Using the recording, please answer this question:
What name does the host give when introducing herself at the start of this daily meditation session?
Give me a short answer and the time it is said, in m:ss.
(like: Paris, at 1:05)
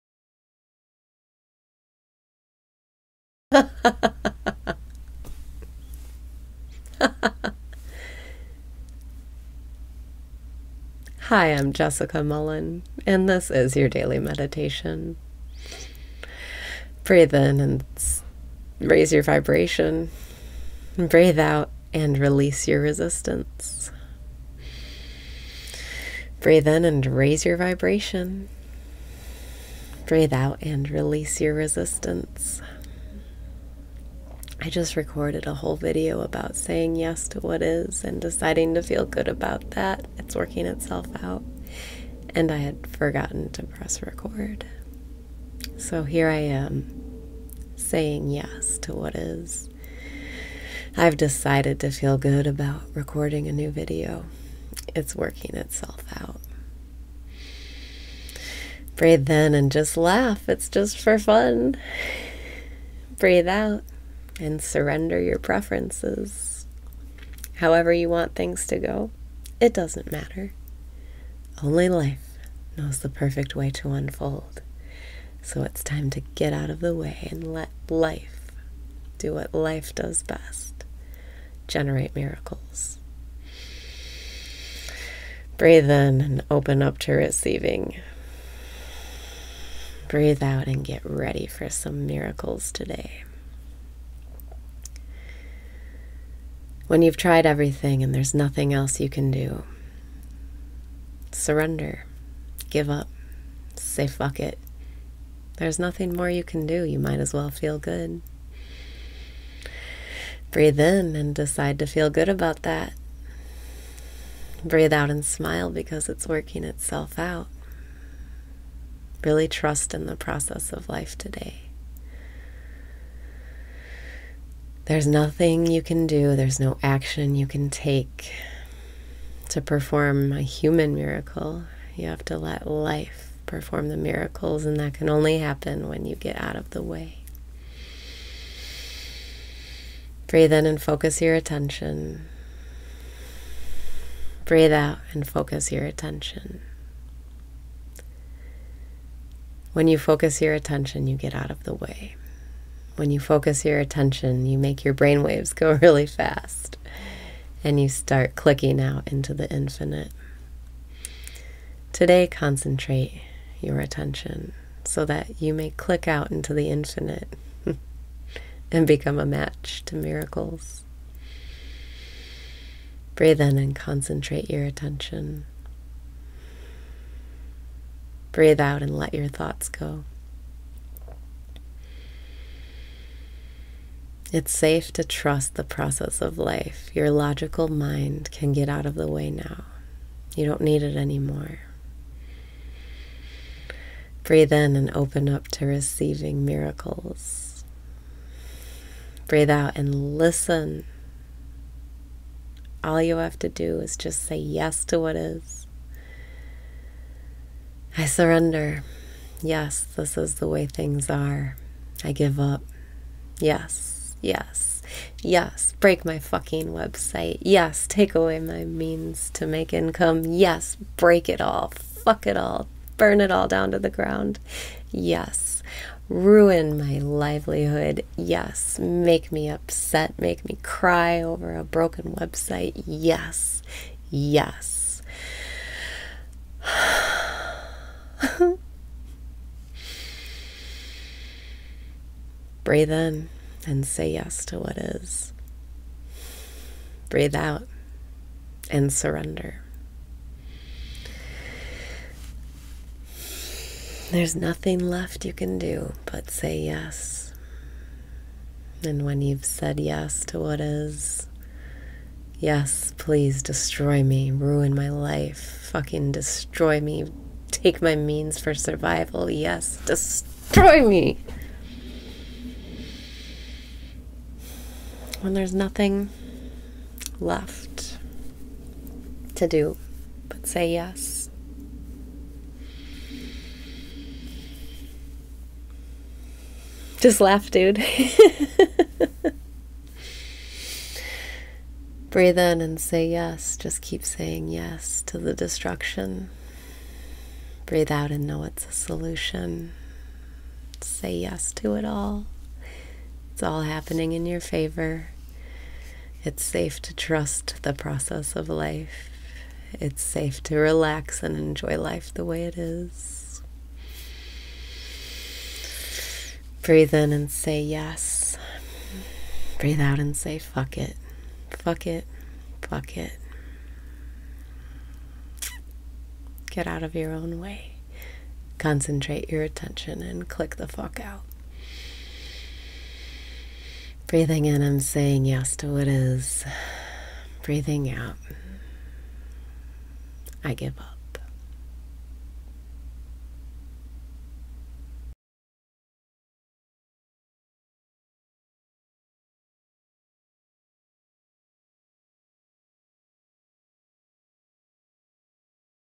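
Jessica Mullen, at 0:11.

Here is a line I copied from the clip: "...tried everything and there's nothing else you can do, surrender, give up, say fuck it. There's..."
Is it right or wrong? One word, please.
right.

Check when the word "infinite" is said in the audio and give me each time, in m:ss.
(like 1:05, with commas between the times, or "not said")
2:39, 2:46.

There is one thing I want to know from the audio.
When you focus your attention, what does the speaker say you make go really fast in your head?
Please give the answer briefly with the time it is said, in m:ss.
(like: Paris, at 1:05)
Brain waves, at 2:34.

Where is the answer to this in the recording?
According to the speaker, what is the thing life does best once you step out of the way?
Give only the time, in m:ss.
1:21.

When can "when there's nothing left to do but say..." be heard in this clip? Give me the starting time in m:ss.
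4:35.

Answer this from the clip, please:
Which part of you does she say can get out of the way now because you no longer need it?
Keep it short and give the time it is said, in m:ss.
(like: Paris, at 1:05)
Logical mind, at 3:07.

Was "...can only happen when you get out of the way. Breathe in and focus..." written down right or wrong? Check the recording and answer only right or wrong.
right.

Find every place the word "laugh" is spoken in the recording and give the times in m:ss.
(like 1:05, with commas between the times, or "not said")
0:59, 4:47.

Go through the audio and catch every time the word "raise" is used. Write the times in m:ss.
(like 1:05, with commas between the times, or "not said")
0:18, 0:27.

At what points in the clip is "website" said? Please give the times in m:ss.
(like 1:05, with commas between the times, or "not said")
3:36, 3:52.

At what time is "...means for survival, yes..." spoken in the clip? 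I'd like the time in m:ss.
4:27.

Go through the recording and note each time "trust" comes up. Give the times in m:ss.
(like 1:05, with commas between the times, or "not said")
1:59, 3:05, 5:06.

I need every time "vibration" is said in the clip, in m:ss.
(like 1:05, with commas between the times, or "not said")
0:19, 0:27.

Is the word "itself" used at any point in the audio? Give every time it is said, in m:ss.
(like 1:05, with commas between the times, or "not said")
0:40, 0:55, 1:56.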